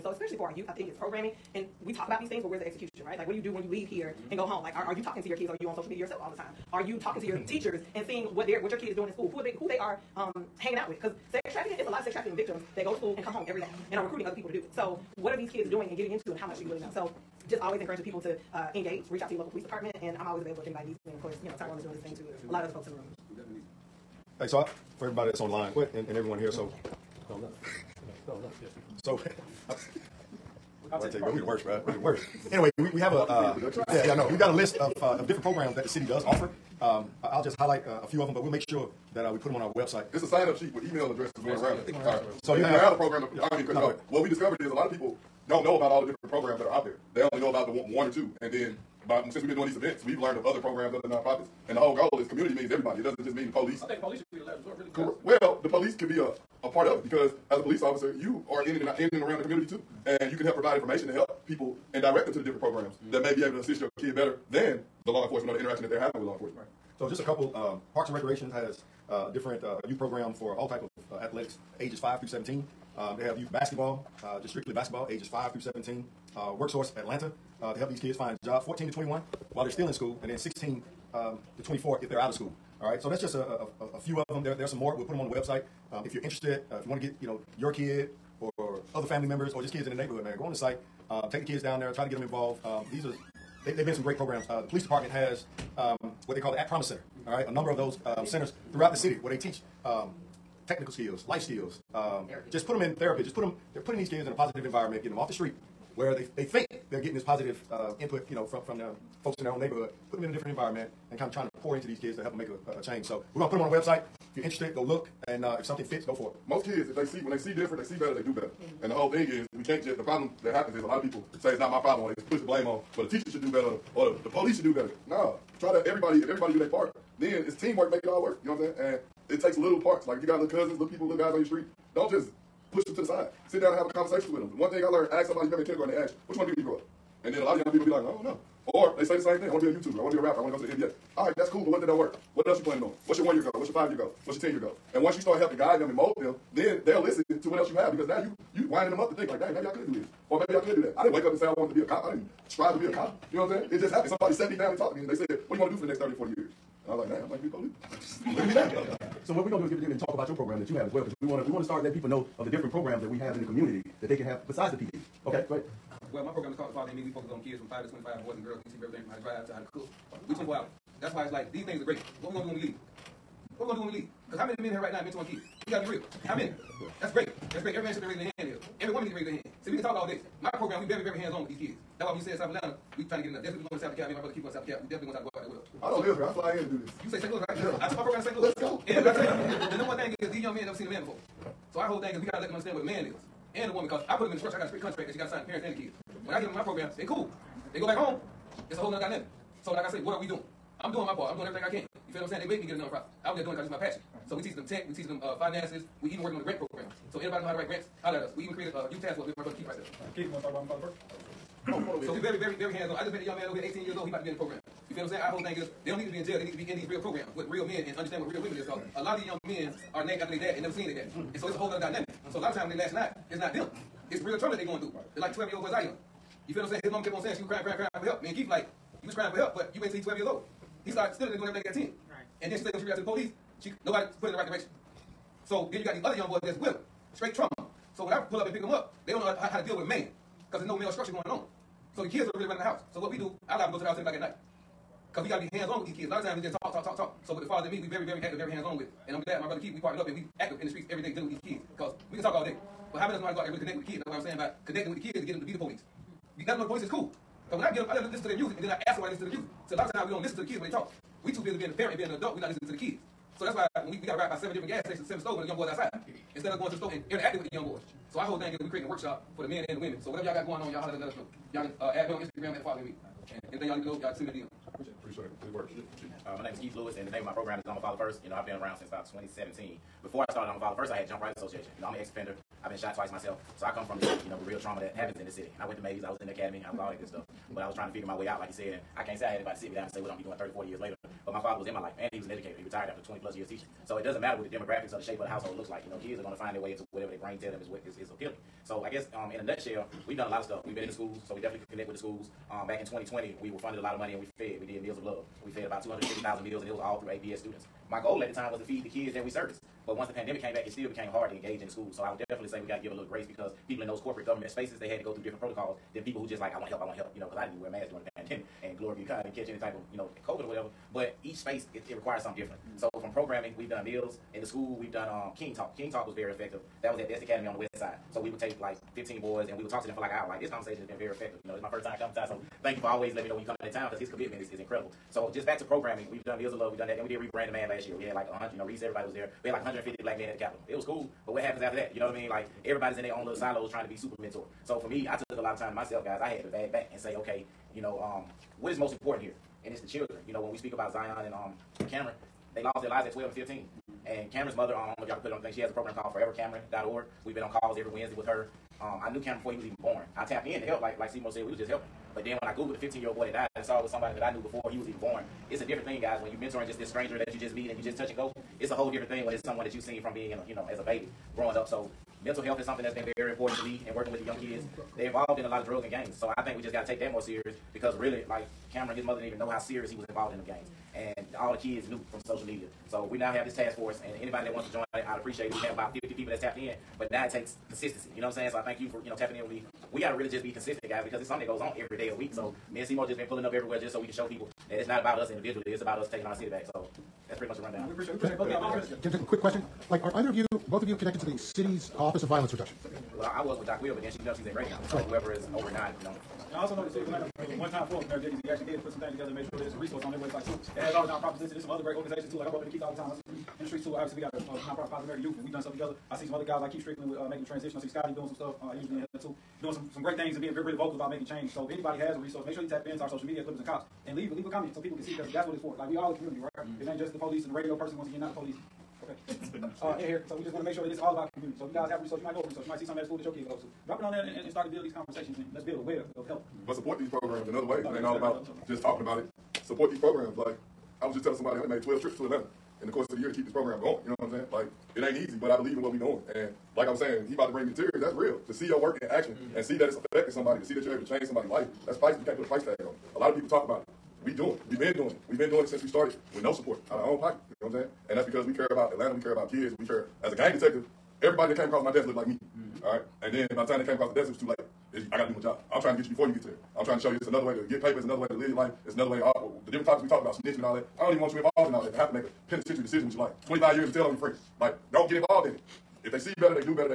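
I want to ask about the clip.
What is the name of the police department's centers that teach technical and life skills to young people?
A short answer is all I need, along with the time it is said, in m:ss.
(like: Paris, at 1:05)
At Promise Center, at 1:36.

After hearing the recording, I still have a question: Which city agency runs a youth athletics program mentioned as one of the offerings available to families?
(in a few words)
Parks and Recreation.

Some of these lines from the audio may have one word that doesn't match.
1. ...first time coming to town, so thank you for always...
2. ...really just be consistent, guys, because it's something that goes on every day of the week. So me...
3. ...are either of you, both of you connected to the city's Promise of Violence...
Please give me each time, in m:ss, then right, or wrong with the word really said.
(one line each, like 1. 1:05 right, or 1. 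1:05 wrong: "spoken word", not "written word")
1. 5:31 right
2. 6:30 right
3. 6:40 wrong: "Office", not "Promise".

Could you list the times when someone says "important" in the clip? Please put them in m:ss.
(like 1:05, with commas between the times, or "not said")
5:48, 6:13.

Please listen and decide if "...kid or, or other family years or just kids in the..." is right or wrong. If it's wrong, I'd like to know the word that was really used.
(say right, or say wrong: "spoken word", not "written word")
wrong: "members", not "years".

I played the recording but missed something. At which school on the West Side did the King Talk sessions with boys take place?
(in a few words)
Best Academy.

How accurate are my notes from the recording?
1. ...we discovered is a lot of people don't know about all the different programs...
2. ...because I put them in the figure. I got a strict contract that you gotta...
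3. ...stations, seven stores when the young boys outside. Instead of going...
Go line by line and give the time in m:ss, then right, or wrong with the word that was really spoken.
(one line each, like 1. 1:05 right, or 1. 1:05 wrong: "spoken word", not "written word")
1. 0:44 right
2. 3:13 wrong: "structure", not "figure"
3. 4:24 right.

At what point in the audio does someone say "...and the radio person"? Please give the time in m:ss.
7:07.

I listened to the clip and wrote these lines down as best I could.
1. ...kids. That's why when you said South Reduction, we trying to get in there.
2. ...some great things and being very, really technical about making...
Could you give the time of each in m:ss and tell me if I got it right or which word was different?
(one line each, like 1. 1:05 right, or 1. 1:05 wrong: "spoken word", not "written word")
1. 3:01 wrong: "Atlanta", not "Reduction"
2. 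6:59 wrong: "vocal", not "technical".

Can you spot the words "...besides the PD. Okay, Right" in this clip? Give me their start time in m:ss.
2:44.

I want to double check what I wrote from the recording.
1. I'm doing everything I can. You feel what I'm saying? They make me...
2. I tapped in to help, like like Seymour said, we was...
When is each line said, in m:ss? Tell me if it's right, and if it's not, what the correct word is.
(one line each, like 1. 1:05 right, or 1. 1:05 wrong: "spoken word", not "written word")
1. 3:21 right
2. 6:00 right.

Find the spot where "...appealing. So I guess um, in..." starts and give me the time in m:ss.
4:58.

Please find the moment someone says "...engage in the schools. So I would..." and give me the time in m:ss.
5:11.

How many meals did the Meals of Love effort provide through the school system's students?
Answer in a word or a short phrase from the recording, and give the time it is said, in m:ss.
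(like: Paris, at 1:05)
250,000, at 5:05.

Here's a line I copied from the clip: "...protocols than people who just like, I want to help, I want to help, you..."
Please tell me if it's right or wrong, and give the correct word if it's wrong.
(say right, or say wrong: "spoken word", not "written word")
right.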